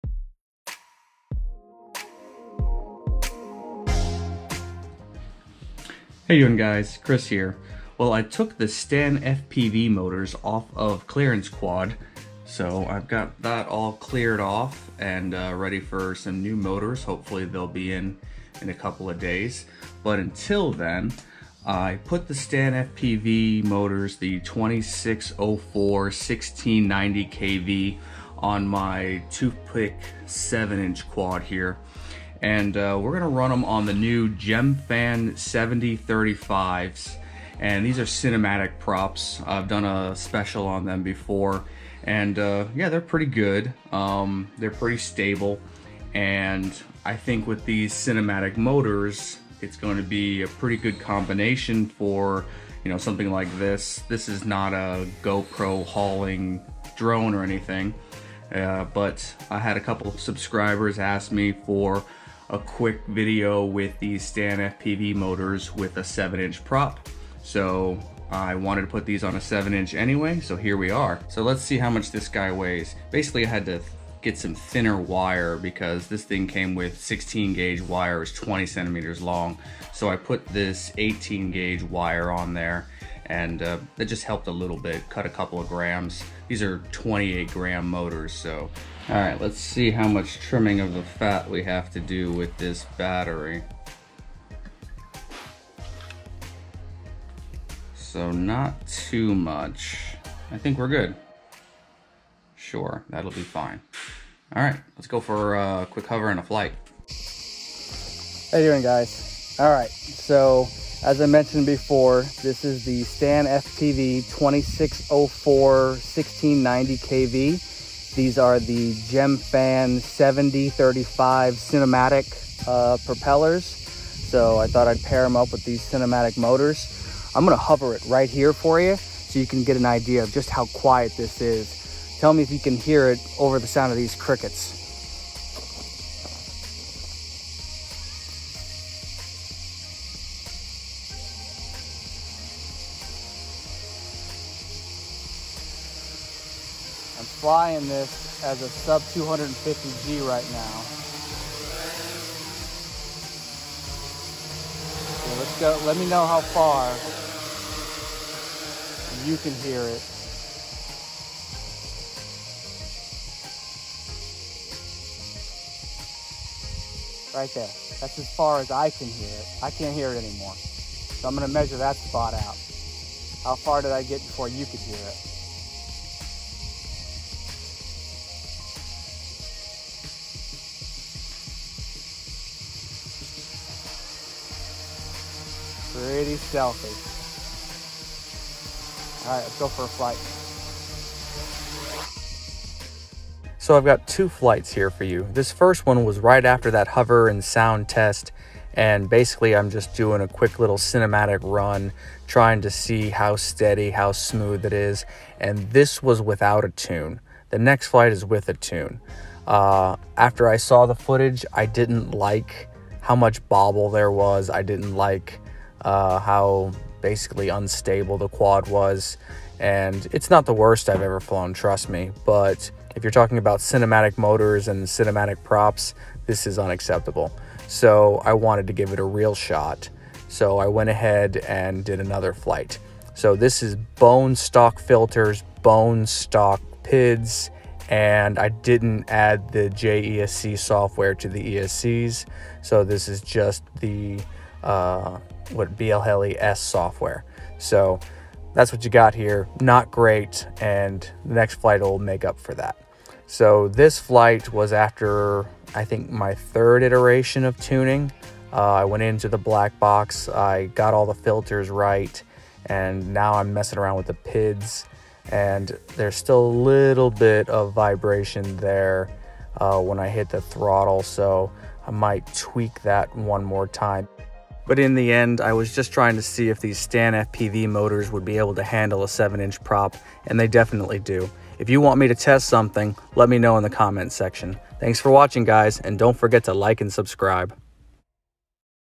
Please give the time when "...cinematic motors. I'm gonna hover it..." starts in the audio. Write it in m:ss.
2:05.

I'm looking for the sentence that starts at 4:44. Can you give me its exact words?
Thanks for watching, guys, and don't forget to like and subscribe.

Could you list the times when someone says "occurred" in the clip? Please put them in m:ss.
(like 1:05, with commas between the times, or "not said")
not said.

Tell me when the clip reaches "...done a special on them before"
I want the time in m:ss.
0:39.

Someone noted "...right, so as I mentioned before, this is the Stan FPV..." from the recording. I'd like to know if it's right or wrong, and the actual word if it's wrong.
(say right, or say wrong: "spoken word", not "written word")
right.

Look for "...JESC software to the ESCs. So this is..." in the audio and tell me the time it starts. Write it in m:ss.
3:59.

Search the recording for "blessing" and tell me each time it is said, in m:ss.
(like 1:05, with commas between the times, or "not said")
not said.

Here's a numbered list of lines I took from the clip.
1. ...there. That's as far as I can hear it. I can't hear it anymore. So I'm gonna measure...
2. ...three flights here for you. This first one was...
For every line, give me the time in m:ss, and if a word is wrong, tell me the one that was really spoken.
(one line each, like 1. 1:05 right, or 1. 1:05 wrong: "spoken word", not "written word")
1. 2:47 right
2. 3:14 wrong: "two", not "three".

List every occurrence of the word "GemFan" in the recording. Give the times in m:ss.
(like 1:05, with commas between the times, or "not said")
0:34, 1:58.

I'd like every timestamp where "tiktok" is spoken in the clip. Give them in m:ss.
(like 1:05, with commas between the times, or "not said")
not said.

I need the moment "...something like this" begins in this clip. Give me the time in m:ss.
0:52.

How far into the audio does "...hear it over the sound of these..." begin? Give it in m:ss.
2:12.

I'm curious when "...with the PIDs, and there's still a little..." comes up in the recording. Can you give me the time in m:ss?
4:23.